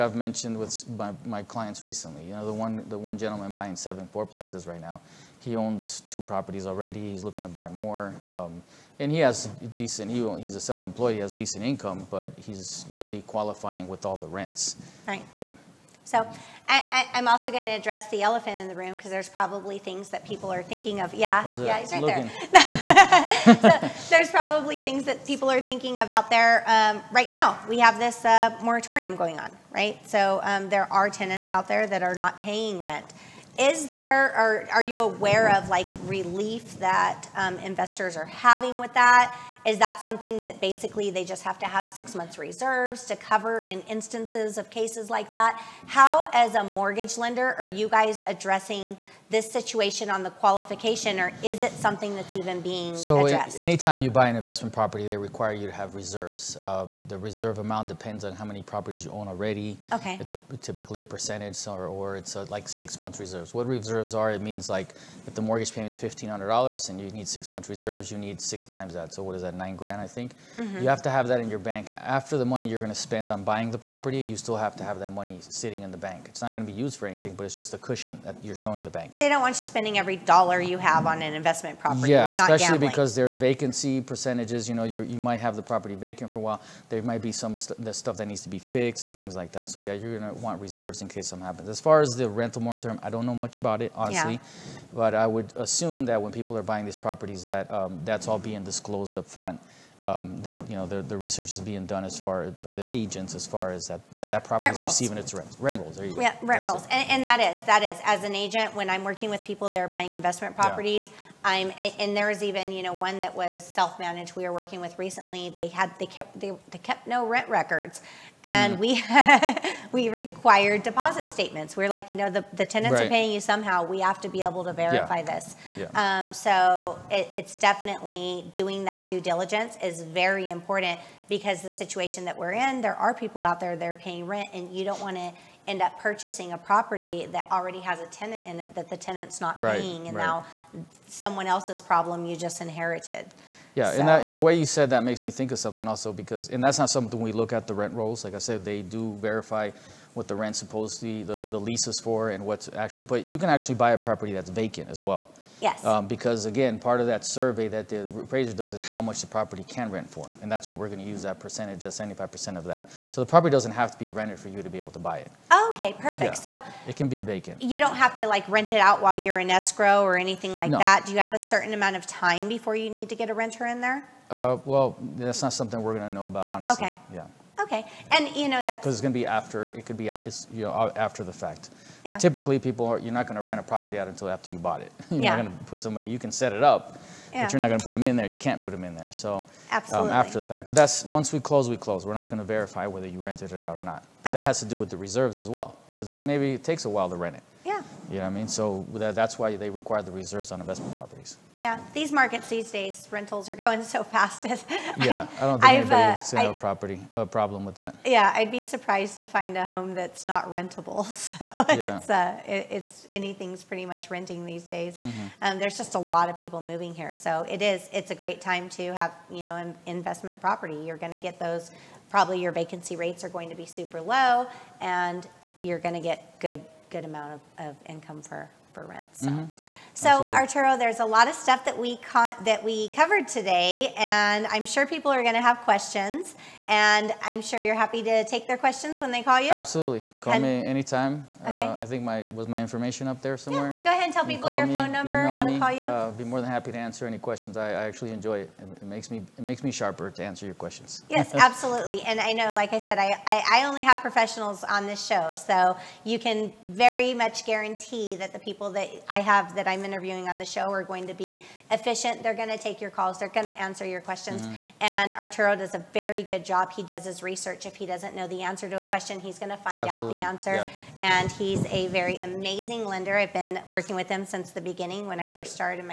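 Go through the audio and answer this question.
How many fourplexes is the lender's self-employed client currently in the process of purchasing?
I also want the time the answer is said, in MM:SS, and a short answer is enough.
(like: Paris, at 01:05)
7, at 00:03.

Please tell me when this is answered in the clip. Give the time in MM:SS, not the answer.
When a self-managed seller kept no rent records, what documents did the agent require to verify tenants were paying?
02:00.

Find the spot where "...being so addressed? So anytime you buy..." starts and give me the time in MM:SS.
00:52.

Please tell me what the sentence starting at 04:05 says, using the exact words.
Uh, be more than happy to answer any questions.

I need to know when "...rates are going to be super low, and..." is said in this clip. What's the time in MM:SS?
03:42.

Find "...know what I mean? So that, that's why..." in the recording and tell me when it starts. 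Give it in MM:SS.
03:18.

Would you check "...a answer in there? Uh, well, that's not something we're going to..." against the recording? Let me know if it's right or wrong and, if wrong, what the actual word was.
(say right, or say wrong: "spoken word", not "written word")
wrong: "renter", not "answer".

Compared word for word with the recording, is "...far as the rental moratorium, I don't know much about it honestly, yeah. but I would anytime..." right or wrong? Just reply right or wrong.
wrong.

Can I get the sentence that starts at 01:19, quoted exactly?
They don't want you spending every dollar you have on an investment property.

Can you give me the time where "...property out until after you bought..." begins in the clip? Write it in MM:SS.
03:03.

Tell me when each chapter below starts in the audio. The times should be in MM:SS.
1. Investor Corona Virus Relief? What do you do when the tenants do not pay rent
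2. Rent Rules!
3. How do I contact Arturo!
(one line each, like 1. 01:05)
1. 00:23
2. 01:43
3. 03:51.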